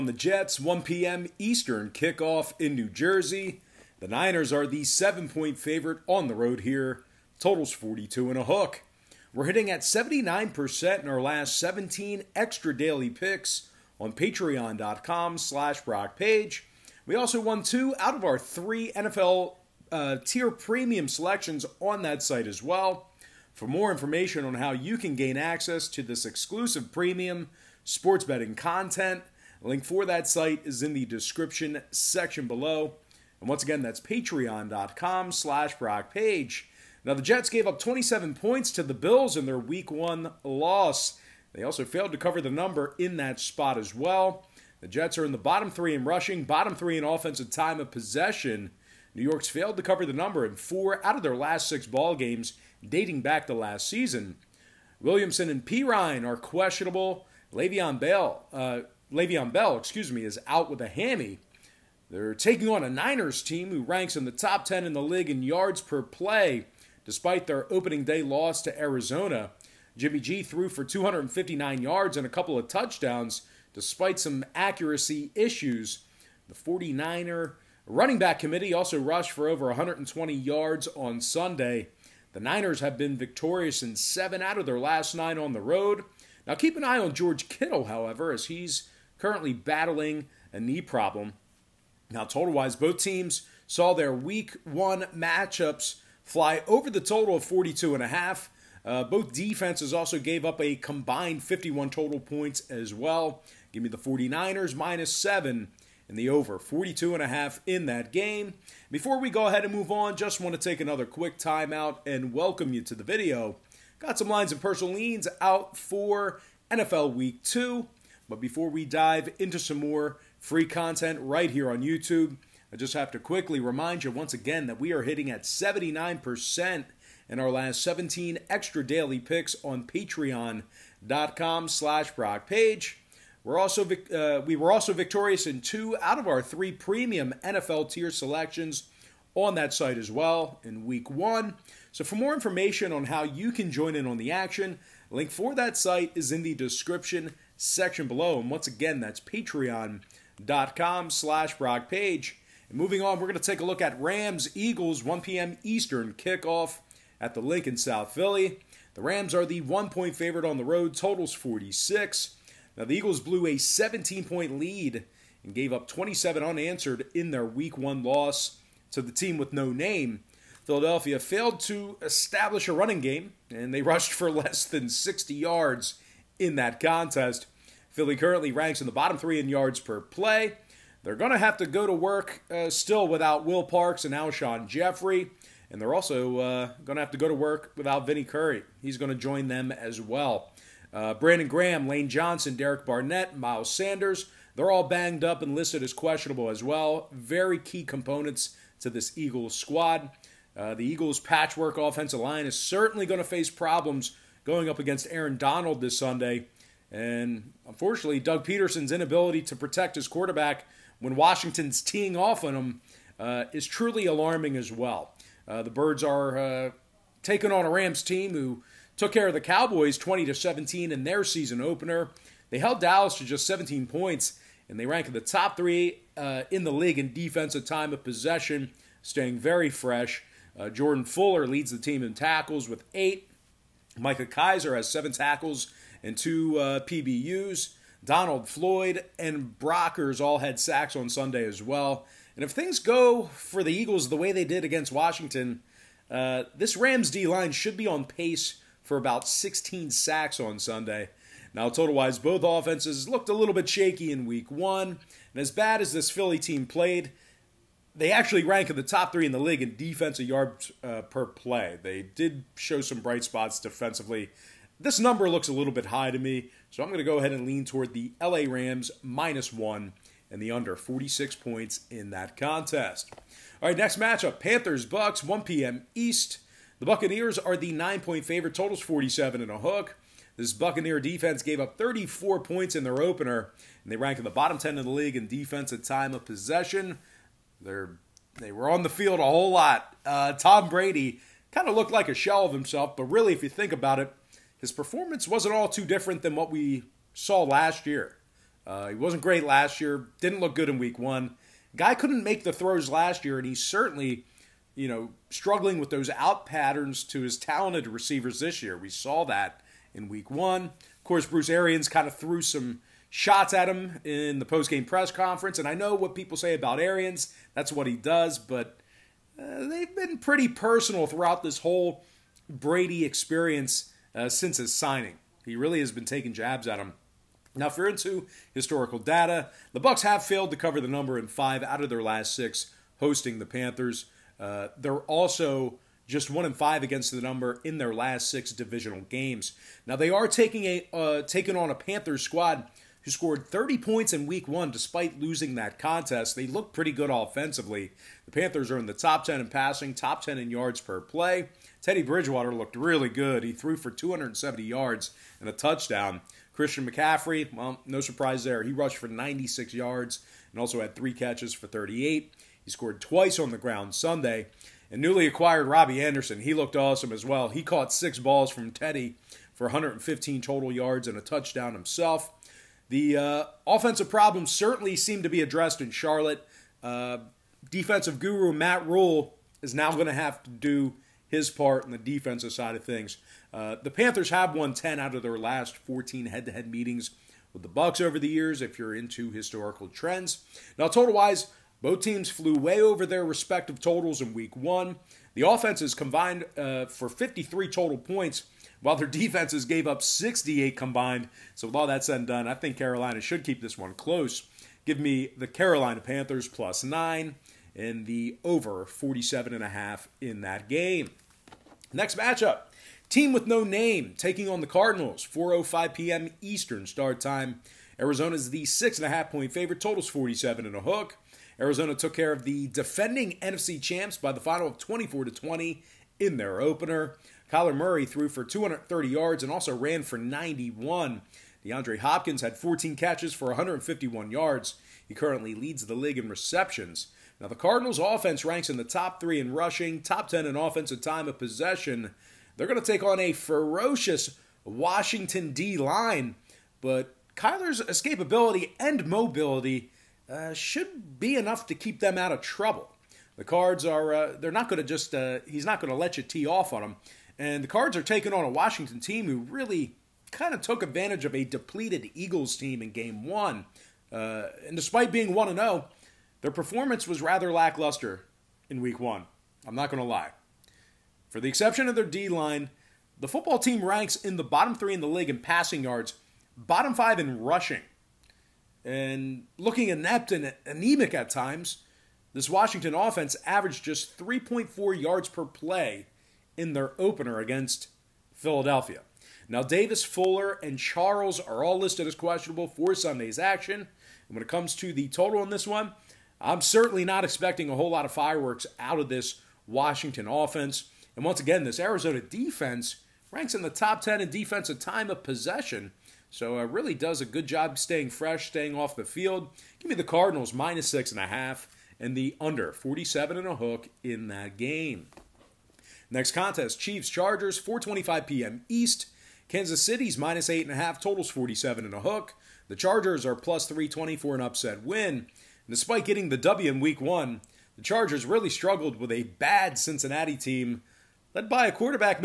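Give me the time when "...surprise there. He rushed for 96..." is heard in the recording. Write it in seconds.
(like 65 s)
358 s.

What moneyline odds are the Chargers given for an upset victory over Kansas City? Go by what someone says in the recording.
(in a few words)
+320.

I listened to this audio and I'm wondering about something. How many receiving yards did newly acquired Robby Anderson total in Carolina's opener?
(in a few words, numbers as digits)
115.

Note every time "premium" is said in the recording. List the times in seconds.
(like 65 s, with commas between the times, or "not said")
20 s, 26 s, 136 s.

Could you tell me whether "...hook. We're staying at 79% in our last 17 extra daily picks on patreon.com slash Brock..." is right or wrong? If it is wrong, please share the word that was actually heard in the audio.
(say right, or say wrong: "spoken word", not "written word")
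wrong: "hitting", not "staying".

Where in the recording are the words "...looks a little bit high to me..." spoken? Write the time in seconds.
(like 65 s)
265 s.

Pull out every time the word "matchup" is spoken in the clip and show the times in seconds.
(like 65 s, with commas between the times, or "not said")
95 s, 273 s, 412 s.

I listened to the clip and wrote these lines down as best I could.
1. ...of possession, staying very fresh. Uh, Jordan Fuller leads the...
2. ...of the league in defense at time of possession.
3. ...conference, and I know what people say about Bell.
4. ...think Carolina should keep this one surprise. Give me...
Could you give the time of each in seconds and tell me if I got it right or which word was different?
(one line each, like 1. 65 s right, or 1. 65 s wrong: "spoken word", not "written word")
1. 227 s right
2. 284 s right
3. 315 s wrong: "Arians", not "Bell"
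4. 402 s wrong: "close", not "surprise".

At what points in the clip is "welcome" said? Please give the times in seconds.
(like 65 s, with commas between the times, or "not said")
112 s.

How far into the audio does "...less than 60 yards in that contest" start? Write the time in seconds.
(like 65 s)
174 s.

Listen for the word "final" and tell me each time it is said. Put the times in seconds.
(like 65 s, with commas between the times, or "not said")
424 s.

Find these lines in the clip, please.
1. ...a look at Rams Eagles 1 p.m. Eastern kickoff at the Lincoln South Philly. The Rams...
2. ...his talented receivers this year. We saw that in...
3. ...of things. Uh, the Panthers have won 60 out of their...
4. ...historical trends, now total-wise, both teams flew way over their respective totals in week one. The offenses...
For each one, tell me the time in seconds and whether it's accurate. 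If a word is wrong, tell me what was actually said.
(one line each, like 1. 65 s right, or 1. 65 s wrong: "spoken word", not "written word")
1. 153 s right
2. 307 s right
3. 382 s wrong: "10", not "60"
4. 389 s right.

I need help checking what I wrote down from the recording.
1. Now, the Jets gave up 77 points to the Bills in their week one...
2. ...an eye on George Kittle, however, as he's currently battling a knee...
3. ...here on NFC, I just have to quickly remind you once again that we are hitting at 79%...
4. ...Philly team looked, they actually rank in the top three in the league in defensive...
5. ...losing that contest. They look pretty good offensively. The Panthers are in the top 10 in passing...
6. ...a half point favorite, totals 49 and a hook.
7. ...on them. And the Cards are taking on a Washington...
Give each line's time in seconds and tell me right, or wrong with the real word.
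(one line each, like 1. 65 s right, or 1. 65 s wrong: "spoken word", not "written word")
1. 37 s wrong: "27", not "77"
2. 86 s right
3. 121 s wrong: "YouTube", not "NFC"
4. 256 s wrong: "played", not "looked"
5. 345 s right
6. 419 s wrong: "47", not "49"
7. 456 s right.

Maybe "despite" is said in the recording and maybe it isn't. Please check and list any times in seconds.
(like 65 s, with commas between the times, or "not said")
67 s, 73 s, 344 s, 464 s, 525 s.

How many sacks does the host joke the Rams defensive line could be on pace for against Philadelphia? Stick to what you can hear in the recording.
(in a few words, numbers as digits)
16.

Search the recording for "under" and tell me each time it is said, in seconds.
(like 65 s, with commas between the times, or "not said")
270 s, 512 s.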